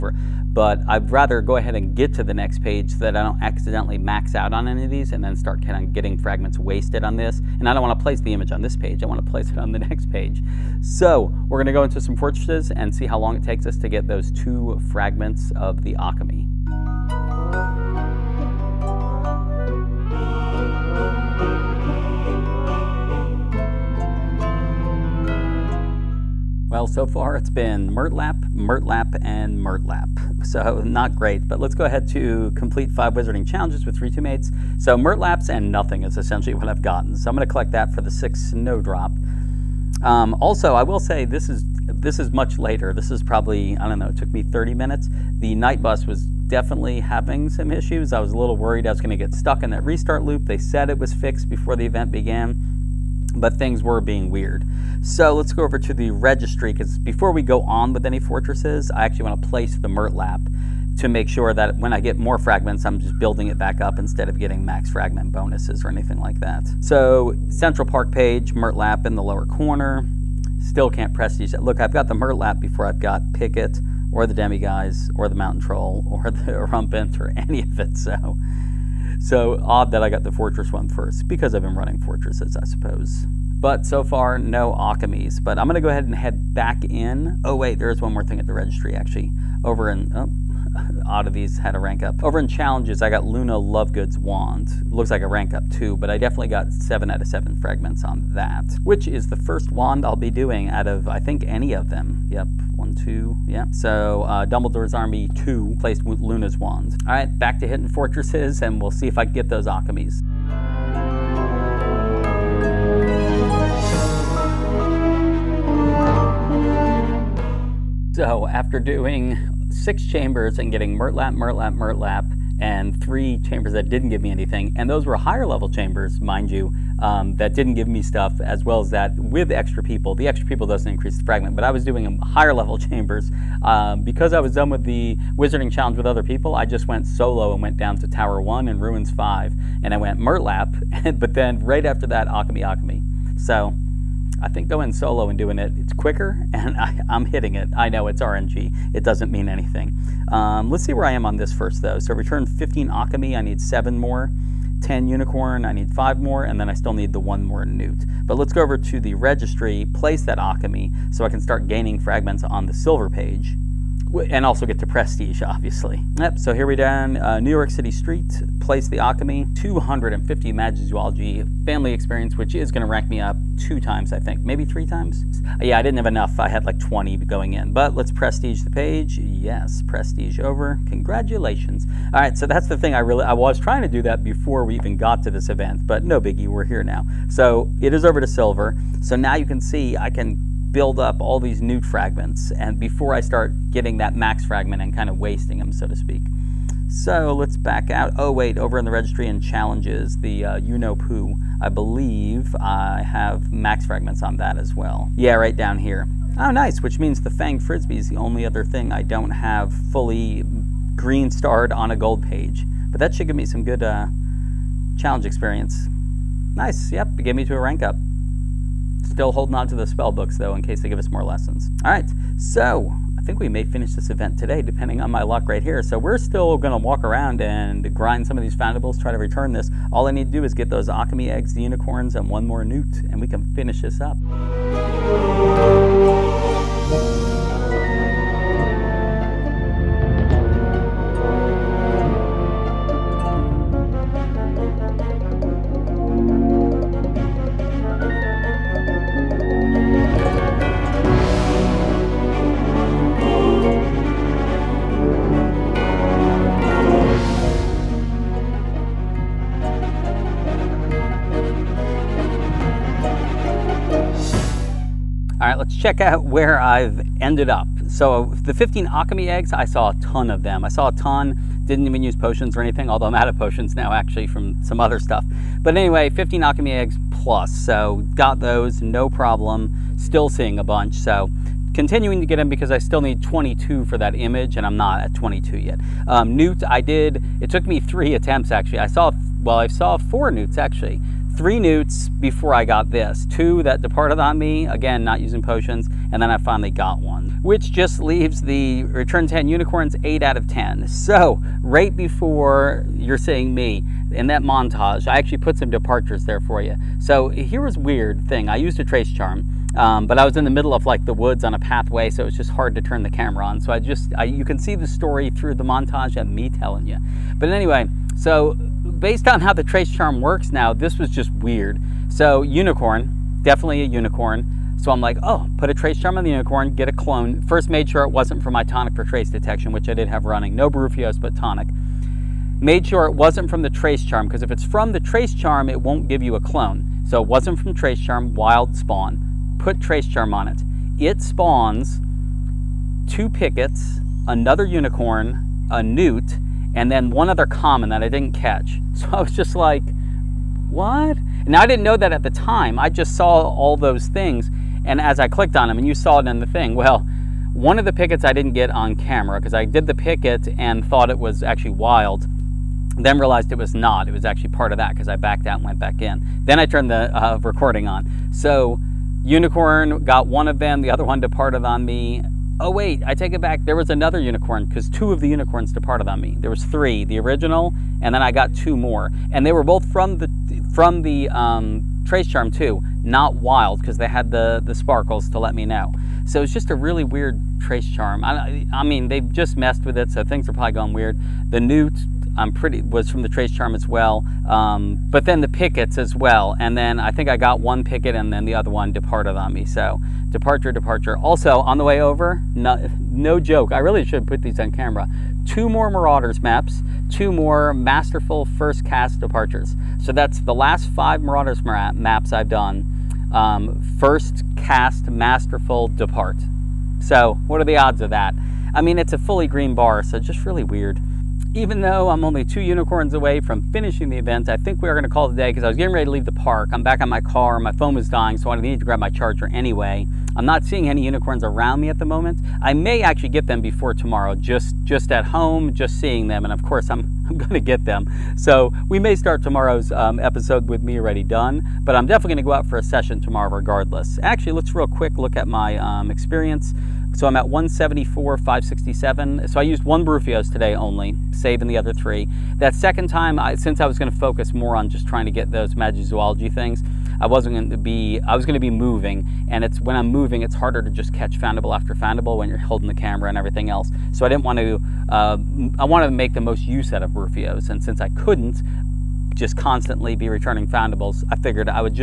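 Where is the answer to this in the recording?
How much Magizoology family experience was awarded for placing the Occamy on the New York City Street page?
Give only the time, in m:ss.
2:49.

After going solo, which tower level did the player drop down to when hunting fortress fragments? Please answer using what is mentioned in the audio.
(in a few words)
Tower 1.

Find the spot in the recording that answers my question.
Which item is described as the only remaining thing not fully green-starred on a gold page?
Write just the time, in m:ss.
3:27.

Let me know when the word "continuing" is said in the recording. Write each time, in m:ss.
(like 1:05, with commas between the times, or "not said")
4:41.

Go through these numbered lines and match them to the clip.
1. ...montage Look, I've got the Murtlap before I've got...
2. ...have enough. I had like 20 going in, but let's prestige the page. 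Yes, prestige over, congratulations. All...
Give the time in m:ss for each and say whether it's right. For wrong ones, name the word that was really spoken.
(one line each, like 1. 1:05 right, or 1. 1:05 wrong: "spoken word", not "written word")
1. 1:11 wrong: "prestige", not "montage"
2. 2:55 right.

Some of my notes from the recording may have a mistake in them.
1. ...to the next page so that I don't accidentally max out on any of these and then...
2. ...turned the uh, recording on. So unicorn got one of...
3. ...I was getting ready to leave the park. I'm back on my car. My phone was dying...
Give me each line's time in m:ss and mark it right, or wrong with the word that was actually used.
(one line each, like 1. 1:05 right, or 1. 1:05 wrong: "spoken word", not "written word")
1. 0:02 right
2. 6:06 right
3. 7:05 right.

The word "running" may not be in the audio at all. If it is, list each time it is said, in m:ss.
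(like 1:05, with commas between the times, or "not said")
1:21, 5:30.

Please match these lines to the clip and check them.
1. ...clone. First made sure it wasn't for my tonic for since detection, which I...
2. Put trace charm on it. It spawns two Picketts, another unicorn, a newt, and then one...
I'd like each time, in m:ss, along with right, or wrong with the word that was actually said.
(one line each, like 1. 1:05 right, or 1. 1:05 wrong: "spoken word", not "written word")
1. 5:26 wrong: "trace", not "since"
2. 5:39 right.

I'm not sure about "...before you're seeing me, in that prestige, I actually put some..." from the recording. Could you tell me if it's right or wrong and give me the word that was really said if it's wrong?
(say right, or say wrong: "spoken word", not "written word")
wrong: "montage", not "prestige".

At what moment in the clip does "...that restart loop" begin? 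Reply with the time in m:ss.
0:49.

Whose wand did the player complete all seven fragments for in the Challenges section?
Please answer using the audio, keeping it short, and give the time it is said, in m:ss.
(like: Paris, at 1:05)
Luna Lovegood, at 1:33.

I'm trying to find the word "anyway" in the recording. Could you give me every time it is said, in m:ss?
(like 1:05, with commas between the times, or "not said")
4:35, 5:17, 7:09.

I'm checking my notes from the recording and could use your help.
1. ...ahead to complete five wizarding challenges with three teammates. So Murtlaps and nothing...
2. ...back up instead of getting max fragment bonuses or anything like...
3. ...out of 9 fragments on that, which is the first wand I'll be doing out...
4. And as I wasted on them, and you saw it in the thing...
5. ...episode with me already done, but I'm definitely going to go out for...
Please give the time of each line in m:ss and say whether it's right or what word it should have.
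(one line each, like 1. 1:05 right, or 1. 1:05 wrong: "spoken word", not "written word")
1. 0:31 right
2. 1:03 right
3. 1:37 wrong: "7", not "9"
4. 5:54 wrong: "clicked", not "wasted"
5. 7:20 right.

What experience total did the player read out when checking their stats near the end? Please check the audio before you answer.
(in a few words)
174,567.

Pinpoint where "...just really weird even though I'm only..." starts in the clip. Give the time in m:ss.
7:00.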